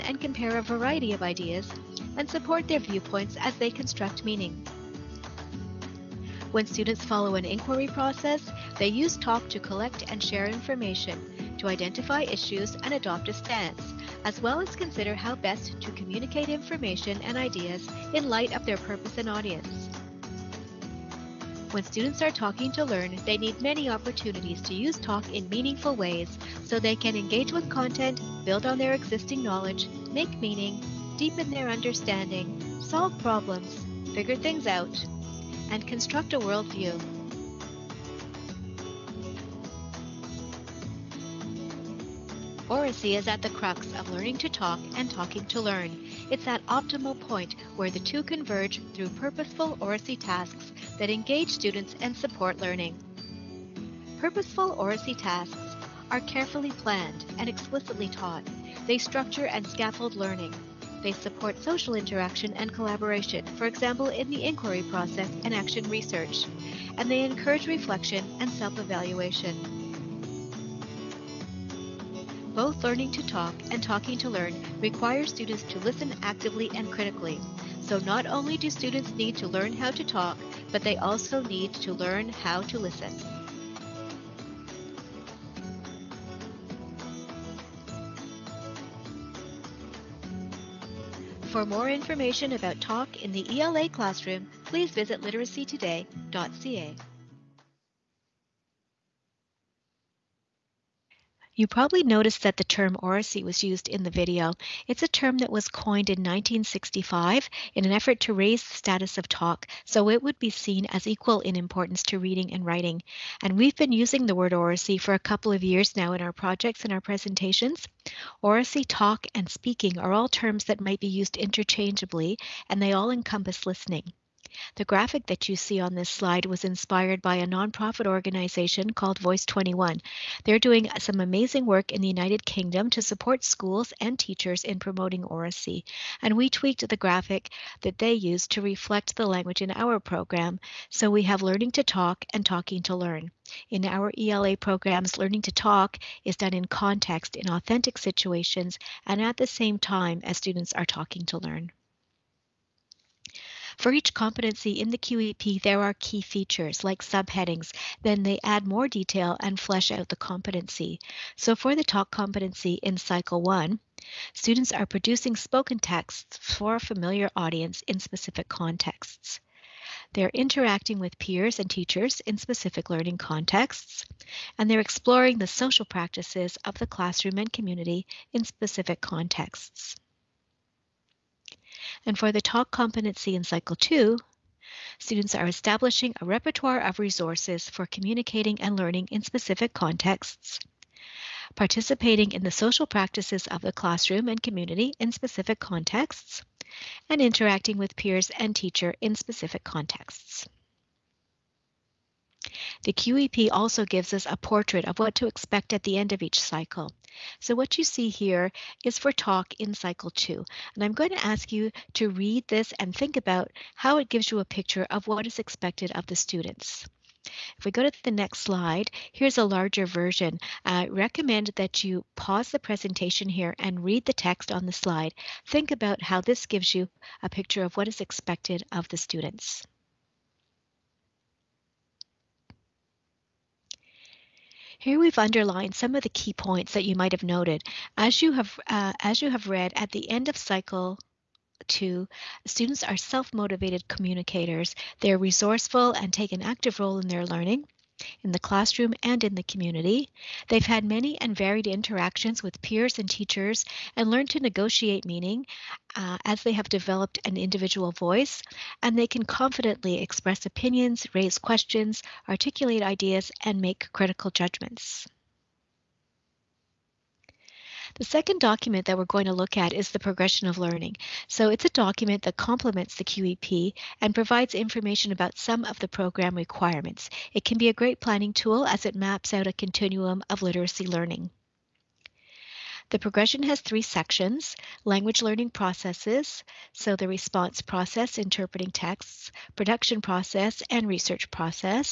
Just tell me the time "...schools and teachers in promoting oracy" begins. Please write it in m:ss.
2:13.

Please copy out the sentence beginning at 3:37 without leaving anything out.
If we go to the next slide, here's a larger version.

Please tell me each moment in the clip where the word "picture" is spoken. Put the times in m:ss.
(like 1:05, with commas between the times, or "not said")
3:34, 3:47.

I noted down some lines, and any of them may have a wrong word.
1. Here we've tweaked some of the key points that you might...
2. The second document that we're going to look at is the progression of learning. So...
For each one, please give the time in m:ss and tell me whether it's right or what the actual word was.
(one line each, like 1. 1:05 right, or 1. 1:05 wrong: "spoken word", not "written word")
1. 3:54 wrong: "underlined", not "tweaked"
2. 4:27 right.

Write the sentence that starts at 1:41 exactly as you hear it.
You probably noticed that the term oracy was used in the video.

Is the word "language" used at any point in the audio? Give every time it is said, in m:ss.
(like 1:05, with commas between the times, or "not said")
2:19, 4:44.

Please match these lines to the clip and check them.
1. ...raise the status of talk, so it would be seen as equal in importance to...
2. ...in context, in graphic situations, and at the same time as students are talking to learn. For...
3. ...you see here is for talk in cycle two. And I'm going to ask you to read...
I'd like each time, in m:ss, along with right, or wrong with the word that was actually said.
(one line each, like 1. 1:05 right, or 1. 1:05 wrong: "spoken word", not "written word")
1. 1:48 right
2. 2:26 wrong: "authentic", not "graphic"
3. 3:27 right.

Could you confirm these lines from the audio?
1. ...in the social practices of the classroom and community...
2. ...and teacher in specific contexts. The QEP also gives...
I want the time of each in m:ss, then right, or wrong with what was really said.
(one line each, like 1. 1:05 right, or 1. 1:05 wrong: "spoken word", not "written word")
1. 3:12 right
2. 3:18 right.